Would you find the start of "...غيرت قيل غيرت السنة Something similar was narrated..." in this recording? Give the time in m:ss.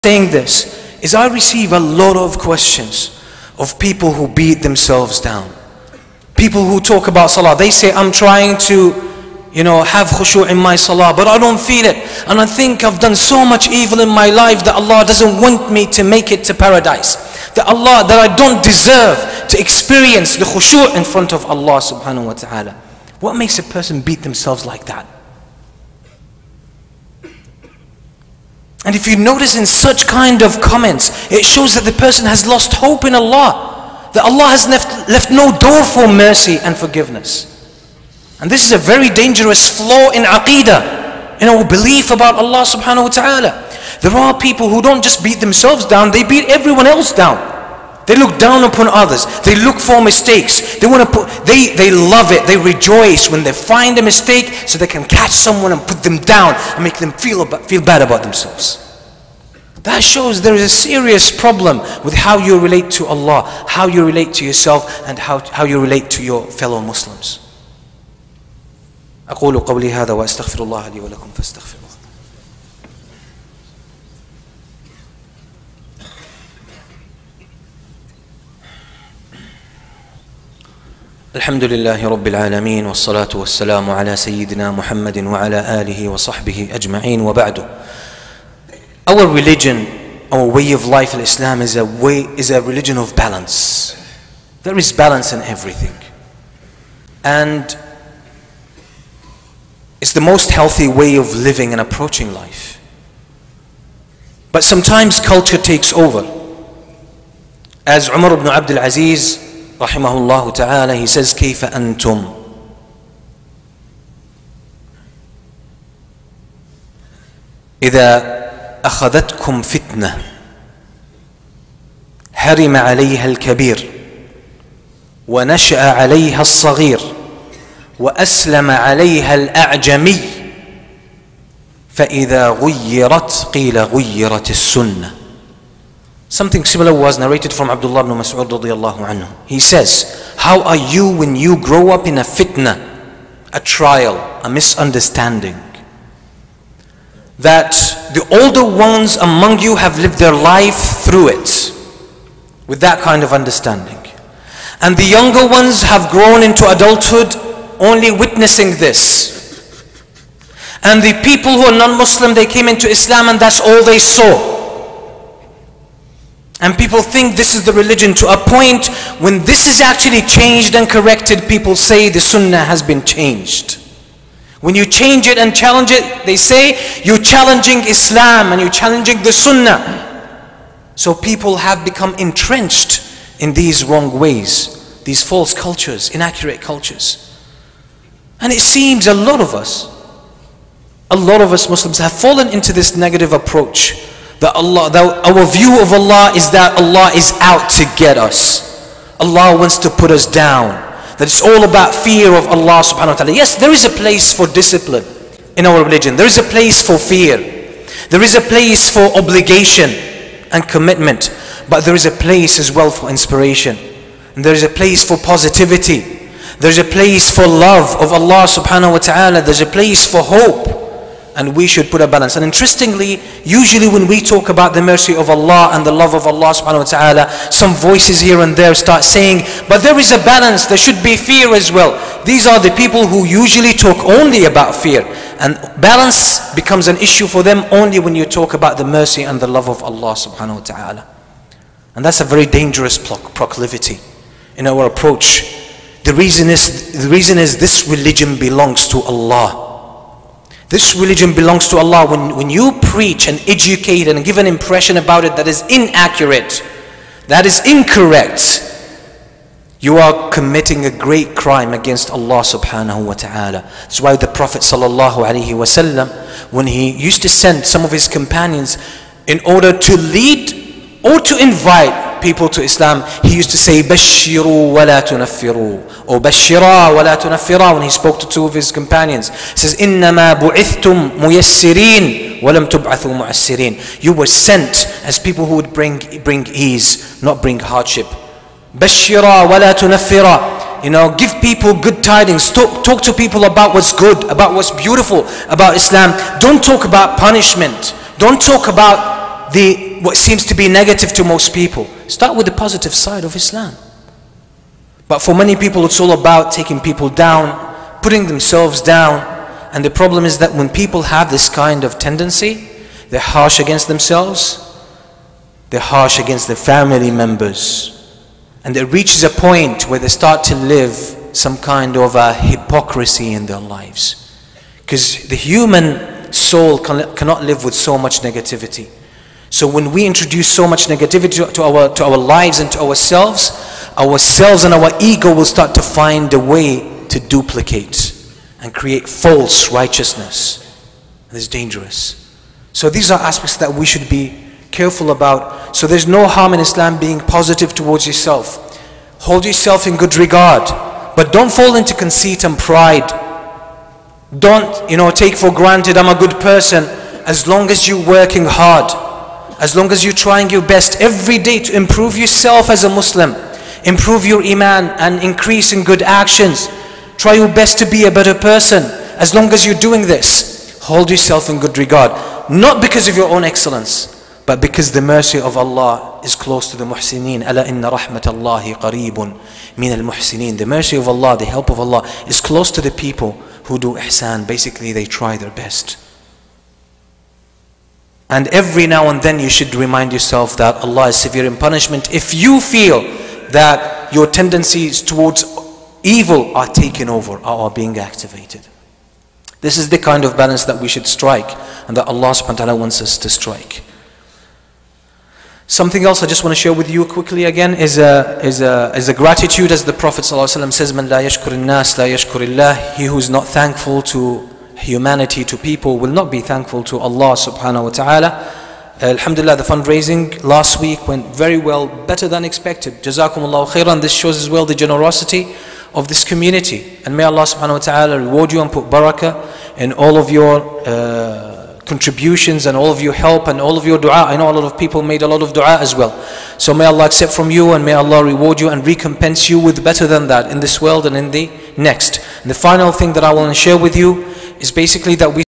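2:12.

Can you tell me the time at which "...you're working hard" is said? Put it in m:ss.
5:57.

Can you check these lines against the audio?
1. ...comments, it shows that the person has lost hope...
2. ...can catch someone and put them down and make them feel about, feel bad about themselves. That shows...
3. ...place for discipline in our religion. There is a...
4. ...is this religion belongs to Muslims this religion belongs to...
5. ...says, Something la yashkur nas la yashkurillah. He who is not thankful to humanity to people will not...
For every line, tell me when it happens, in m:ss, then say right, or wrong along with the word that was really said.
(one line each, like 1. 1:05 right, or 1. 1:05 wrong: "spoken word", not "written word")
1. 0:30 right
2. 0:54 right
3. 3:23 right
4. 4:07 wrong: "Allah", not "Muslims"
5. 6:50 wrong: "Man", not "Something".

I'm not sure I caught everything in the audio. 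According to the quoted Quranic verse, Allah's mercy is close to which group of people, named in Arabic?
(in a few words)
al-muhsineen.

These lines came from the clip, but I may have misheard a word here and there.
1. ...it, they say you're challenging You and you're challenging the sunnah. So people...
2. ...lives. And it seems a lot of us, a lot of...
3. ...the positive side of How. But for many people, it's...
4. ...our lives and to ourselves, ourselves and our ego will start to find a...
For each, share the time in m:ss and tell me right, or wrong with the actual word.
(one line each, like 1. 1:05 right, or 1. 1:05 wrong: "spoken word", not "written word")
1. 2:55 wrong: "Islam", not "You"
2. 3:06 wrong: "cultures", not "lives"
3. 5:02 wrong: "Islam", not "How"
4. 5:32 right.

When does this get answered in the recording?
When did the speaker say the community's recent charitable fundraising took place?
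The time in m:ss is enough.
7:00.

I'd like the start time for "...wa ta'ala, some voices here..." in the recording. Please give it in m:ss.
3:46.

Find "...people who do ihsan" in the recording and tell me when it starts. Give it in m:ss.
6:22.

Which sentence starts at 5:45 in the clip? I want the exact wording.
So there's no harm in Islam being positive towards yourself.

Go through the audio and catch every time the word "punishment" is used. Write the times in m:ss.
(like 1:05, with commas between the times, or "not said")
4:57, 6:31.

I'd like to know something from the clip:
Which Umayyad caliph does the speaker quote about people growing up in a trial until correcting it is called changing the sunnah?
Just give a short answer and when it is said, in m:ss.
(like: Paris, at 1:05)
Umar ibn Abdul Aziz, at 1:48.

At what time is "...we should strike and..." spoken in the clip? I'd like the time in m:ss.
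6:40.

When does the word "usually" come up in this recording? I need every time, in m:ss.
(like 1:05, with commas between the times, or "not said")
3:43, 3:53.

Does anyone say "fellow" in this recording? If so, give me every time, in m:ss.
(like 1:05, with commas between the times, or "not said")
1:06.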